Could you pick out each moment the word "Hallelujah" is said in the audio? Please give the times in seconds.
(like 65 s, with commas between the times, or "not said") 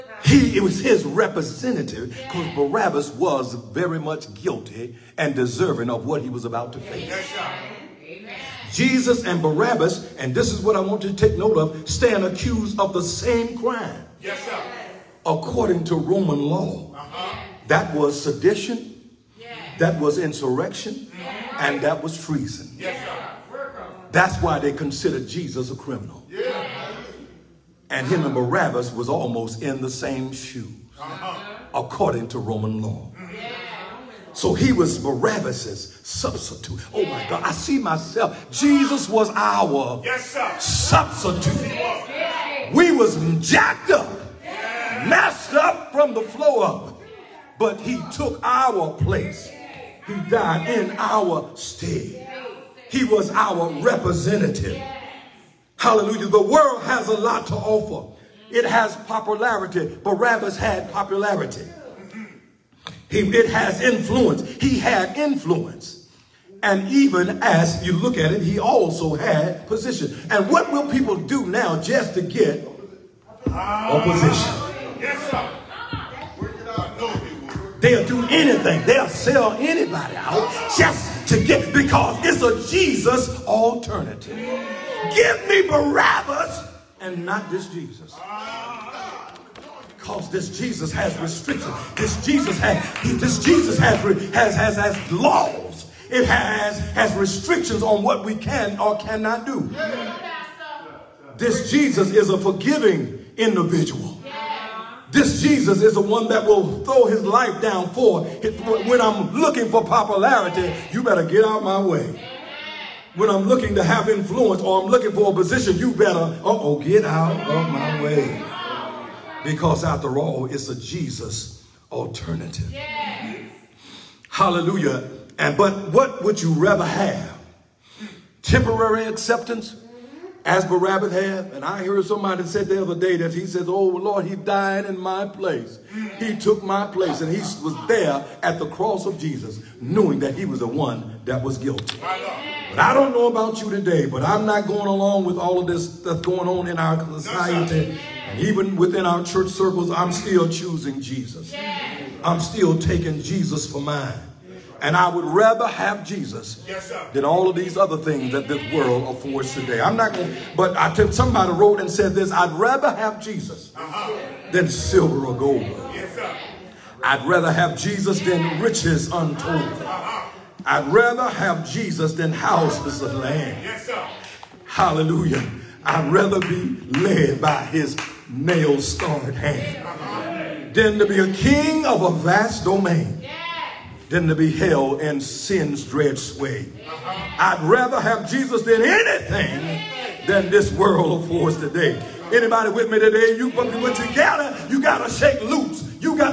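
55 s, 124 s, 174 s.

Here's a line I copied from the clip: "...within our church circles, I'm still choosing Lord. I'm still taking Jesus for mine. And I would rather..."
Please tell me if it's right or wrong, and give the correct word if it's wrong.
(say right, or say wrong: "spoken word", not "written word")
wrong: "Jesus", not "Lord".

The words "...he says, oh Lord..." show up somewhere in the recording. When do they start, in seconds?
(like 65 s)
133 s.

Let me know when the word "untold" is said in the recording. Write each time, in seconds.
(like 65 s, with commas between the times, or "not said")
169 s.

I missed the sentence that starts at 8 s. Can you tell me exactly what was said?
Jesus and Barabbas, and this is what I want you to take note of, stand accused of the same crime.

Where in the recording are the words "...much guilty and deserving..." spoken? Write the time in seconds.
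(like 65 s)
3 s.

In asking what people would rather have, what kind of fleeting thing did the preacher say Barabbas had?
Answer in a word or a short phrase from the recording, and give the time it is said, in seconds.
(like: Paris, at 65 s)
Temporary acceptance, at 128 s.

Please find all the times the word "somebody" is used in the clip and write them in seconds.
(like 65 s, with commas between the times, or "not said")
132 s, 161 s.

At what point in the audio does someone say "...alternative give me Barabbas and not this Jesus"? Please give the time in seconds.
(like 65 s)
83 s.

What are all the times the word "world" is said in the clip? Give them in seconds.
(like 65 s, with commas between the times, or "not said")
56 s, 158 s, 190 s.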